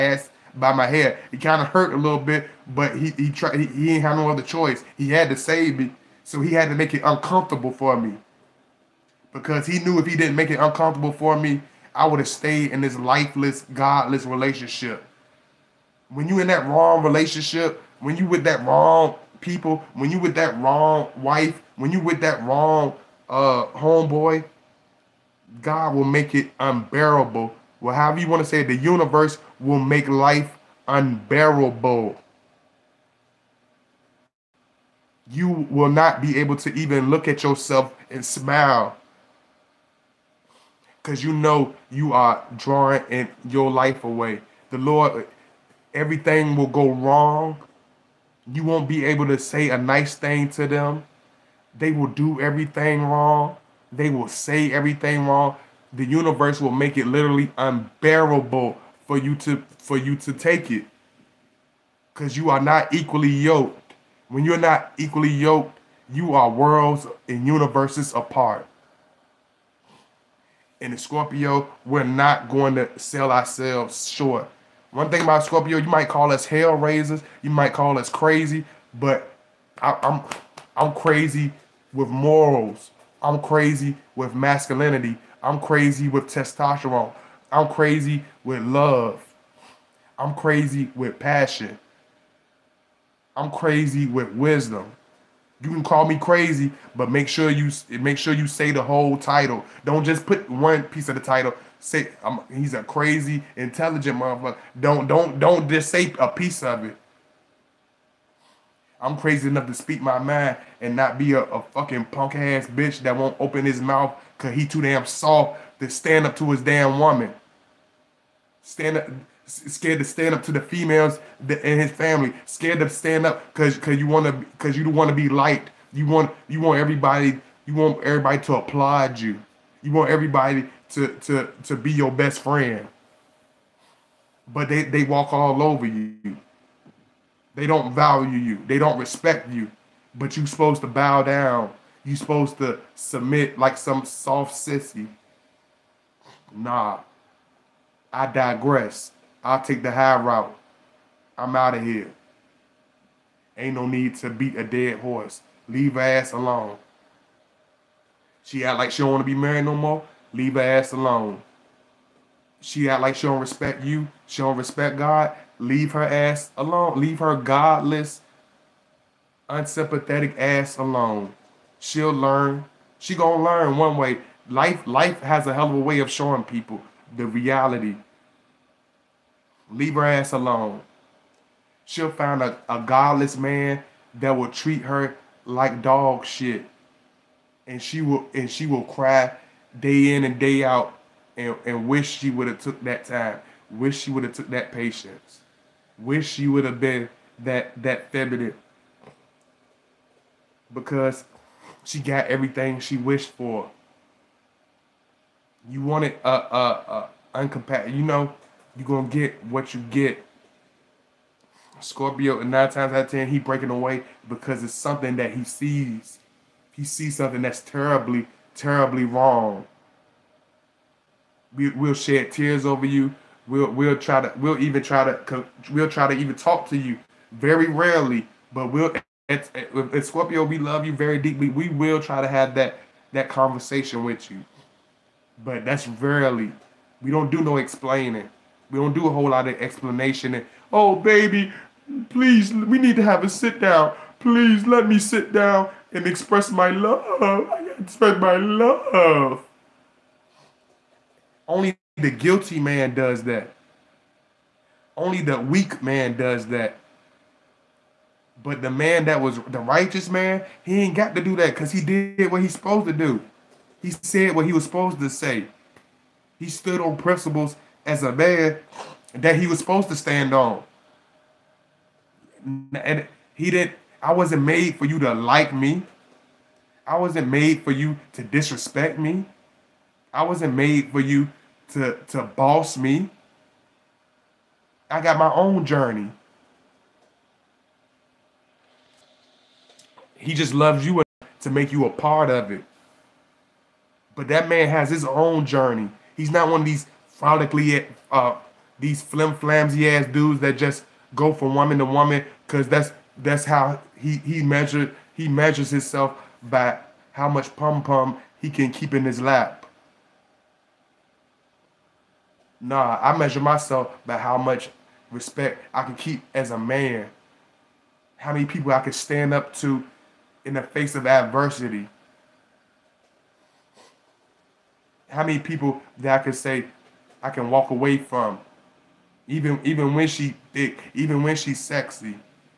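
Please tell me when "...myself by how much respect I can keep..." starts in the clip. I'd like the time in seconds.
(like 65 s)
313 s.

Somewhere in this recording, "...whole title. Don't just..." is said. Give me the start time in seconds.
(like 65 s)
98 s.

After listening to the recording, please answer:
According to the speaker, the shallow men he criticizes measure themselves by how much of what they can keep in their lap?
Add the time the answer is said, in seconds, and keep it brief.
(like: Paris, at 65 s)
Pum pum, at 307 s.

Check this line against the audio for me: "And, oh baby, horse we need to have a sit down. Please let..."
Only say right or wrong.
wrong.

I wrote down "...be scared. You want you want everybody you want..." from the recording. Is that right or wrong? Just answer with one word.
wrong.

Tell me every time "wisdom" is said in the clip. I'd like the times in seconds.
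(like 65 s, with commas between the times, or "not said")
94 s.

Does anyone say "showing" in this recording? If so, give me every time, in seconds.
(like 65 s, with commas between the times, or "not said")
176 s.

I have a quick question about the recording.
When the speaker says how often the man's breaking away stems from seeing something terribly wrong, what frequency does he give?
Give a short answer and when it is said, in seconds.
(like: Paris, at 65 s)
9 times out of 10, at 212 s.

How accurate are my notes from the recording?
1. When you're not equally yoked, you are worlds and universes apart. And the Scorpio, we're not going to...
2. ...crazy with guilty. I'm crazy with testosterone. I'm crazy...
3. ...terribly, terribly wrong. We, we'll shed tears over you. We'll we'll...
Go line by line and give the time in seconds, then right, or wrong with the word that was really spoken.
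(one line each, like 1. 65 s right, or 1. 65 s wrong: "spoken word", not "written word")
1. 64 s right
2. 83 s wrong: "masculinity", not "guilty"
3. 217 s right.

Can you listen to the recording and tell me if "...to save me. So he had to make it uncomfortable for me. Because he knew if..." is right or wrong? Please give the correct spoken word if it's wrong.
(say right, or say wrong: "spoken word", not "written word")
right.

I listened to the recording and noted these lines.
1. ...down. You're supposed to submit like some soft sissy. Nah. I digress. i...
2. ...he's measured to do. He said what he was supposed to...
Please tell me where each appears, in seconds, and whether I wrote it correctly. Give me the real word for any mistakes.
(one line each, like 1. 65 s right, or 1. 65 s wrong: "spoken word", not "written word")
1. 141 s right
2. 262 s wrong: "supposed", not "measured".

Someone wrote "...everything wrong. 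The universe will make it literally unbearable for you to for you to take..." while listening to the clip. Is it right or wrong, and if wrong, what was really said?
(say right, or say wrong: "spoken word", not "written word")
right.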